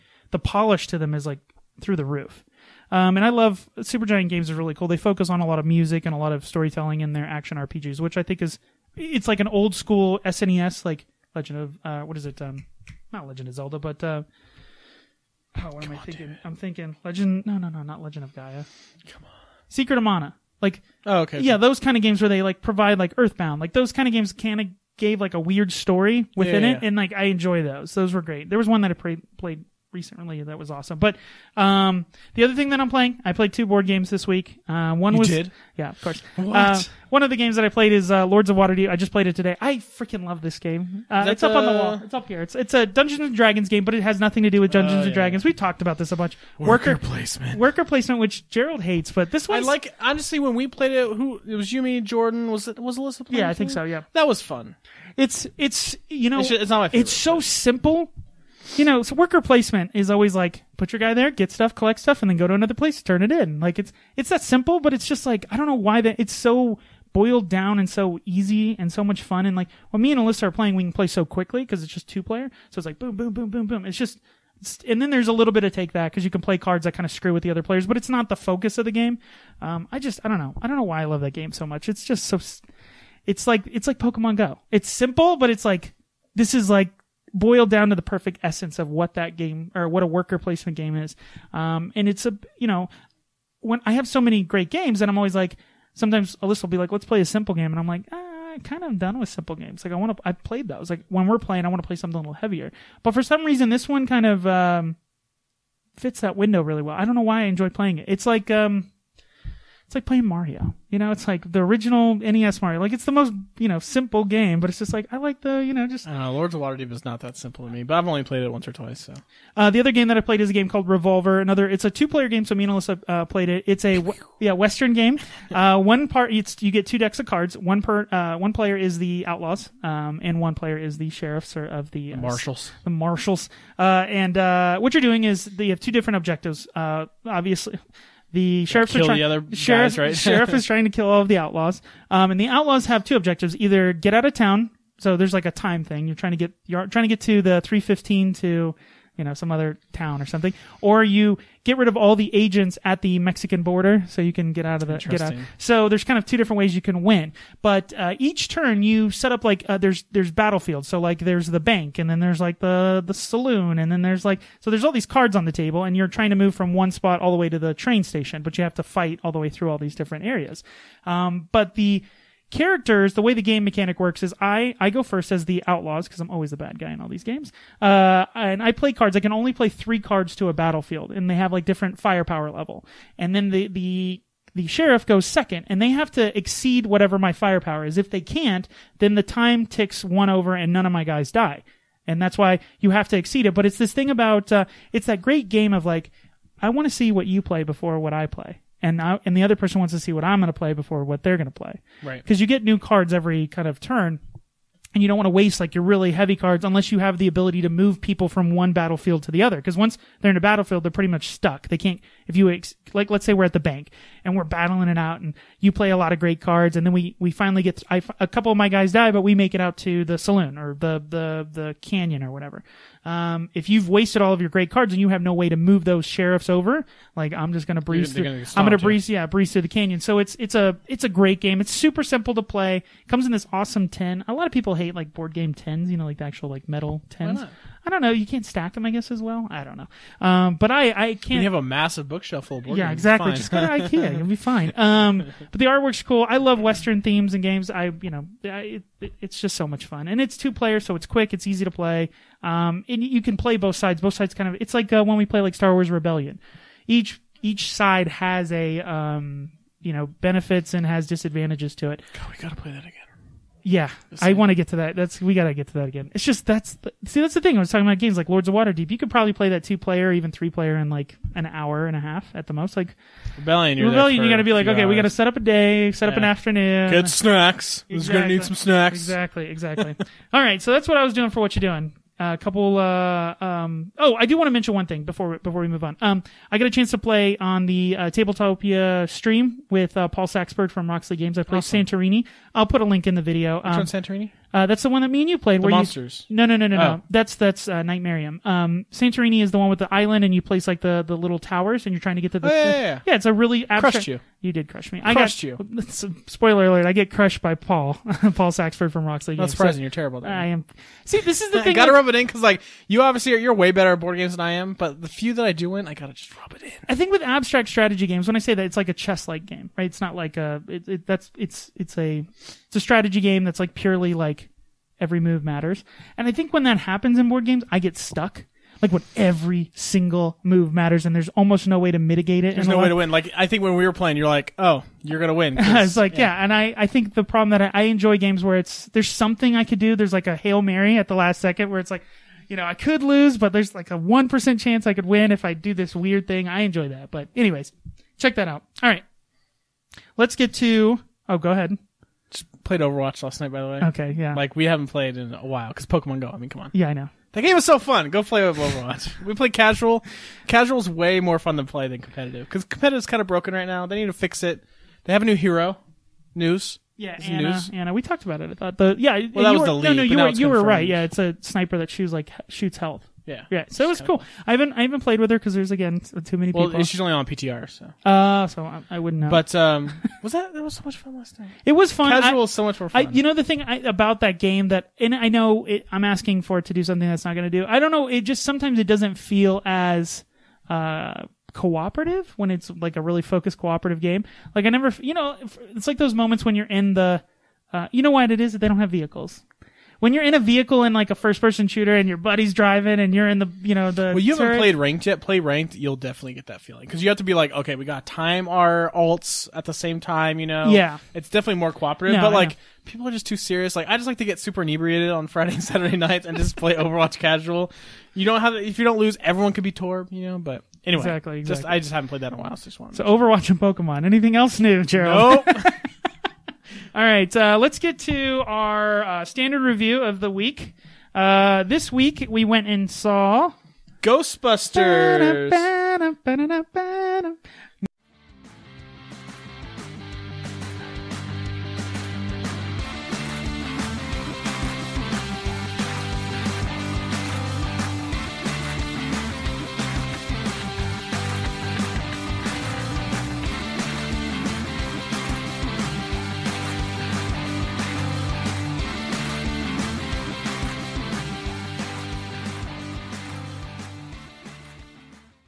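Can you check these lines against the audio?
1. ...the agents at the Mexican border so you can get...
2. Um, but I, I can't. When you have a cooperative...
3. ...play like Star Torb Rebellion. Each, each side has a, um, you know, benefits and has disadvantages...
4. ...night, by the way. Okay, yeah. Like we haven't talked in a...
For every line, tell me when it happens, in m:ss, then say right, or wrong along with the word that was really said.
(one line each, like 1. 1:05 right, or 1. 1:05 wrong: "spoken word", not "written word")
1. 2:32 right
2. 4:00 wrong: "massive", not "cooperative"
3. 4:15 wrong: "Wars", not "Torb"
4. 5:53 wrong: "played", not "talked".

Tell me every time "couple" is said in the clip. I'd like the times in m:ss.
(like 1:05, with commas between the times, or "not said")
3:38, 4:42.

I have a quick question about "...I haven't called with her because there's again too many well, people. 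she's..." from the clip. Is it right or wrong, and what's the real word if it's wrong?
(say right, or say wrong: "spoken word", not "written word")
wrong: "played", not "called".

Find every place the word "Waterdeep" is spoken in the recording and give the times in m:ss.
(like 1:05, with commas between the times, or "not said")
0:38, 1:56, 4:28.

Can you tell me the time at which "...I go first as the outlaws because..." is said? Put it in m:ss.
2:54.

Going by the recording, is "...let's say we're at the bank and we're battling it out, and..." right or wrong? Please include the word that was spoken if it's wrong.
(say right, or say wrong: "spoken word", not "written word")
right.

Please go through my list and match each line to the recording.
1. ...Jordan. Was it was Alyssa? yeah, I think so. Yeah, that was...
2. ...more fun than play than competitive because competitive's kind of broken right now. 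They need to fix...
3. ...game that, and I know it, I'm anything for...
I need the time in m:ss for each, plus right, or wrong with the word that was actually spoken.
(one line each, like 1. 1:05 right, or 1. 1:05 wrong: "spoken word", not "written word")
1. 0:51 right
2. 6:01 right
3. 6:24 wrong: "asking", not "anything".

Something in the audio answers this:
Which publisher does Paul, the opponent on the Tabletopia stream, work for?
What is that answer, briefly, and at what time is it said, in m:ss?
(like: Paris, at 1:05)
Roxley Games, at 4:50.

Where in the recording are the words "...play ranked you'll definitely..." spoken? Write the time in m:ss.
6:45.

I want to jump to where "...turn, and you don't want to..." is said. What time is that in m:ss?
3:23.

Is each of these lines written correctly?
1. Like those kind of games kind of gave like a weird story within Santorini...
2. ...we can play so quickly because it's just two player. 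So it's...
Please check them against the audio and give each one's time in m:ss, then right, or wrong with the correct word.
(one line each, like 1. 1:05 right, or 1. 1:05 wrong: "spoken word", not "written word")
1. 0:23 wrong: "Yeah", not "Santorini"
2. 1:10 right.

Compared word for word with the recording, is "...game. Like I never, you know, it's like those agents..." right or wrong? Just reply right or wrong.
wrong.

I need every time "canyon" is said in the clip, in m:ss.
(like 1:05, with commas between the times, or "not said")
3:41, 3:49.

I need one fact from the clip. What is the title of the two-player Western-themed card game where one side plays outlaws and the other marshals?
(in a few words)
Revolver.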